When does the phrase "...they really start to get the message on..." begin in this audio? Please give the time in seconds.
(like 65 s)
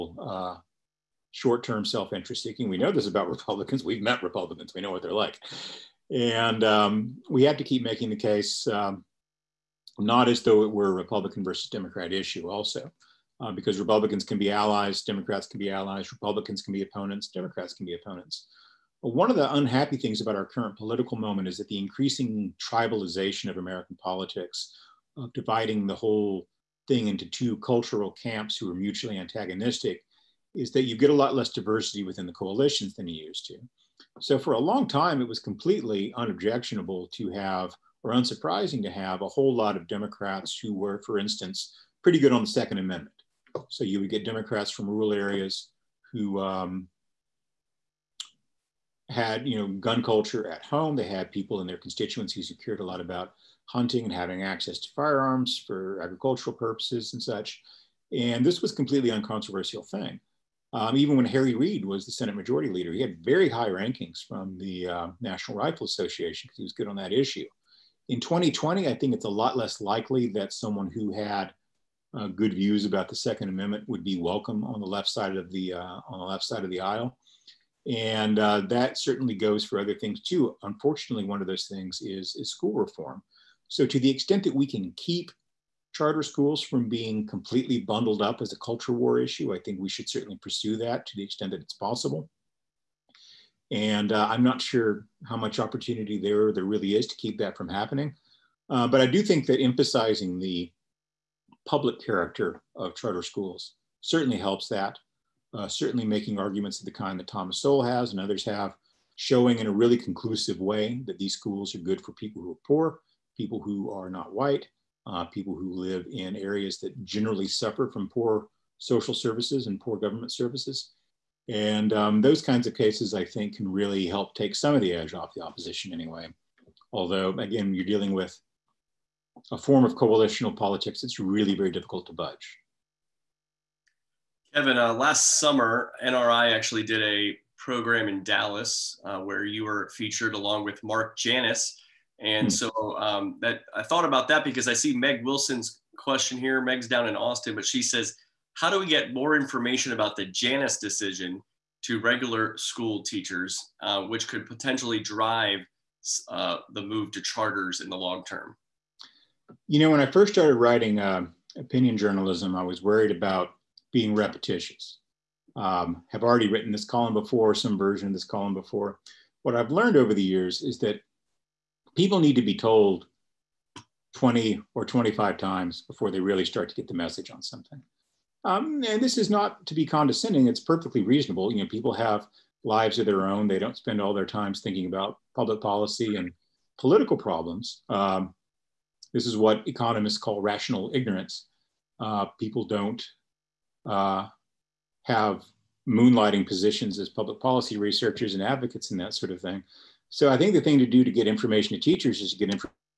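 176 s.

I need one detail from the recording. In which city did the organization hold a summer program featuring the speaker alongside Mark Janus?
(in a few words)
Dallas.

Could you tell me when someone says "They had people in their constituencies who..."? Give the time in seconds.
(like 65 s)
50 s.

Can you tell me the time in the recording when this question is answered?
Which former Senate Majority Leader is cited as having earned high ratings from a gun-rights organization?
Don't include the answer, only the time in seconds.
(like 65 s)
61 s.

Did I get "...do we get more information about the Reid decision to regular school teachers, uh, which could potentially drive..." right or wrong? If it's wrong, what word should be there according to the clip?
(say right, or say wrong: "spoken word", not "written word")
wrong: "Janus", not "Reid".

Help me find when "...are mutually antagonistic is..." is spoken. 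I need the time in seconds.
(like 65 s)
28 s.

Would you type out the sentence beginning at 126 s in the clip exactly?
Although, again, you're dealing with a form of coalitional politics that's really very difficult to budge.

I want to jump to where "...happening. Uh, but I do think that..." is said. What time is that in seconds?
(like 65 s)
97 s.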